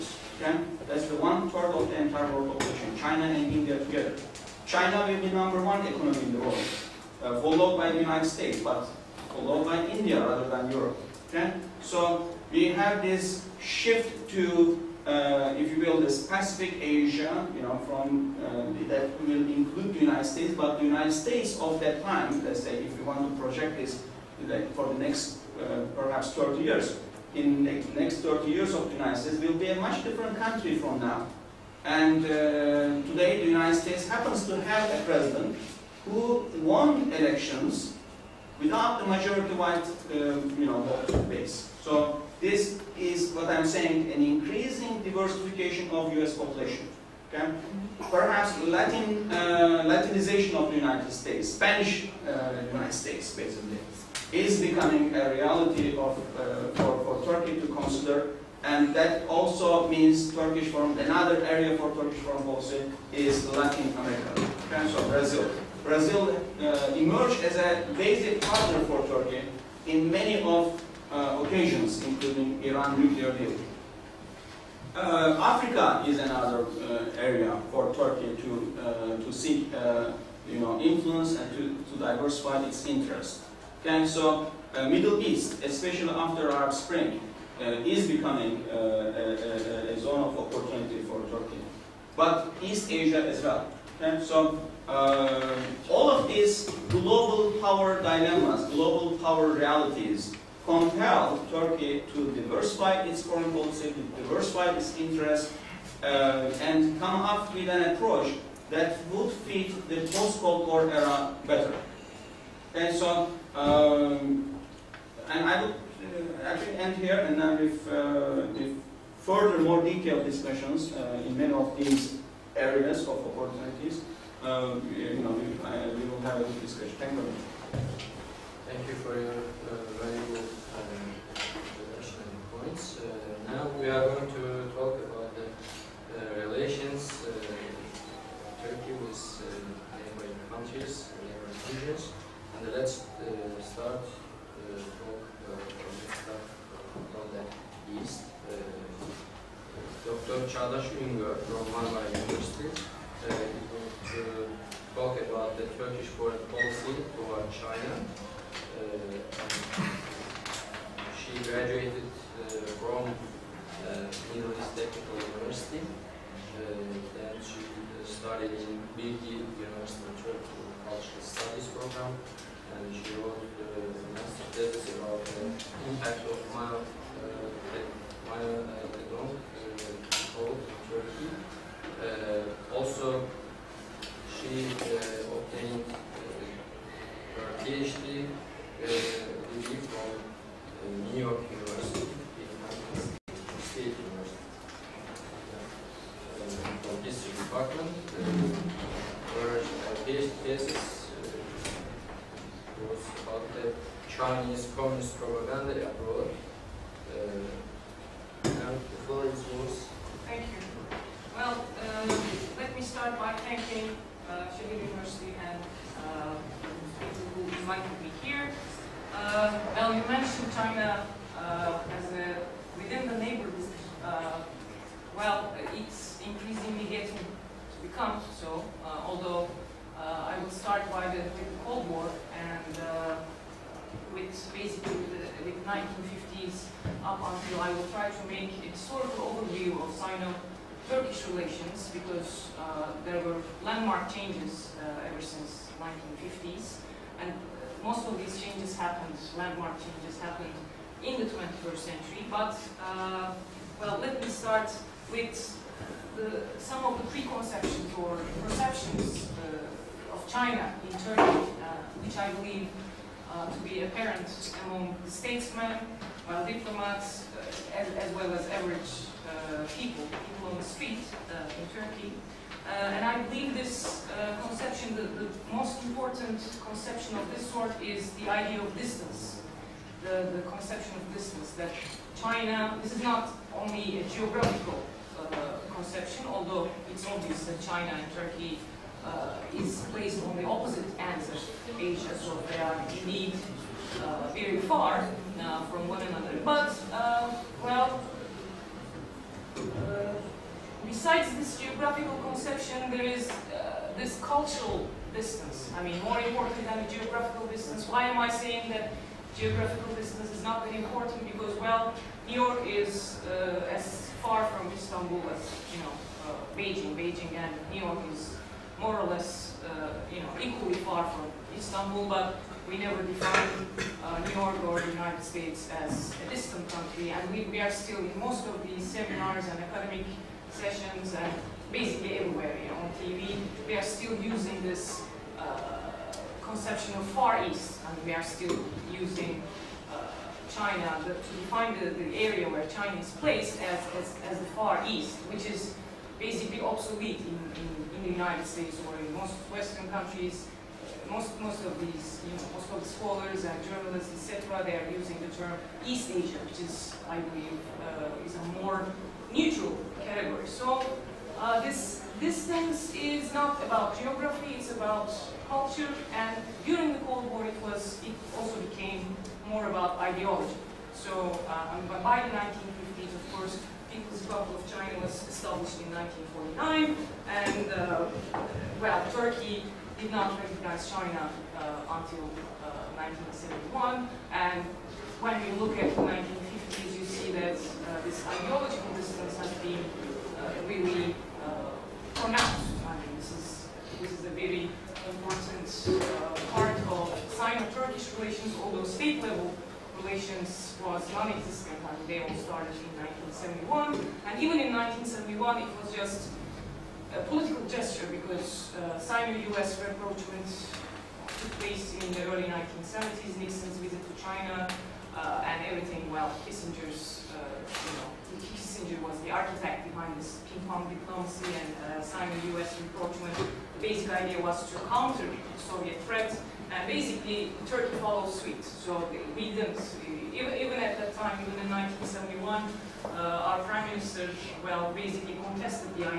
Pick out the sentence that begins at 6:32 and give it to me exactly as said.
I mean, this is, this is a very important uh, part of Sino-Turkish relations, although state-level relations was non-existent.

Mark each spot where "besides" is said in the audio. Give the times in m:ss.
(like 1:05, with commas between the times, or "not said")
5:00.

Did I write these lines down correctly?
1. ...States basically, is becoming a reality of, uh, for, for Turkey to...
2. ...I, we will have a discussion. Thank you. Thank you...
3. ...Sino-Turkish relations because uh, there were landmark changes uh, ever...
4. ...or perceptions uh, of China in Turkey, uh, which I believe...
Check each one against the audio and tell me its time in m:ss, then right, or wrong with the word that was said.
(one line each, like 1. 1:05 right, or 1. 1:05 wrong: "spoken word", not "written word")
1. 0:52 right
2. 2:05 right
3. 3:59 right
4. 4:17 right.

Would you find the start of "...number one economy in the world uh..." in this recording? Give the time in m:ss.
0:05.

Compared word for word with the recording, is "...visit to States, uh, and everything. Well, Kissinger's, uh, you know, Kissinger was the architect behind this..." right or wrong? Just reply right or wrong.
wrong.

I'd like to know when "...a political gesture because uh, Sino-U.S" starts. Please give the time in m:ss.
6:47.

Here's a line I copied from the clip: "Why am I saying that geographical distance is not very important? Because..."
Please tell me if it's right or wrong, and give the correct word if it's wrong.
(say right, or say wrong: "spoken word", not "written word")
right.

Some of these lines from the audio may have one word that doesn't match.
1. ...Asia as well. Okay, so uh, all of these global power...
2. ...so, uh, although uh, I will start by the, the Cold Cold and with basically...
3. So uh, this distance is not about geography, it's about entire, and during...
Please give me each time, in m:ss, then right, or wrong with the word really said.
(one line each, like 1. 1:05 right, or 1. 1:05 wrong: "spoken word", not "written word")
1. 1:32 right
2. 3:48 wrong: "War", not "Cold"
3. 6:00 wrong: "culture", not "entire".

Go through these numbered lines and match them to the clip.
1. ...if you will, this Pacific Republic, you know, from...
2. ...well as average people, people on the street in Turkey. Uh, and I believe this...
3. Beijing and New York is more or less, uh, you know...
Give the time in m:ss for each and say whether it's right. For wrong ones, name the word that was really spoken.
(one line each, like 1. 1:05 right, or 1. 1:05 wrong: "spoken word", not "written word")
1. 0:15 wrong: "Asia", not "Republic"
2. 4:28 right
3. 5:16 right.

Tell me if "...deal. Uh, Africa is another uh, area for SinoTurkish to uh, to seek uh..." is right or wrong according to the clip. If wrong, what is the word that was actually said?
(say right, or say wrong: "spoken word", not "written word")
wrong: "Turkey", not "SinoTurkish".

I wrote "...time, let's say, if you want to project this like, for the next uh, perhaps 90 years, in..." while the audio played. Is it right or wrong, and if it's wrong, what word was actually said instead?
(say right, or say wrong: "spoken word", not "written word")
wrong: "30", not "90".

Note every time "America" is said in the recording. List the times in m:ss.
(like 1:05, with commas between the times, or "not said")
1:03.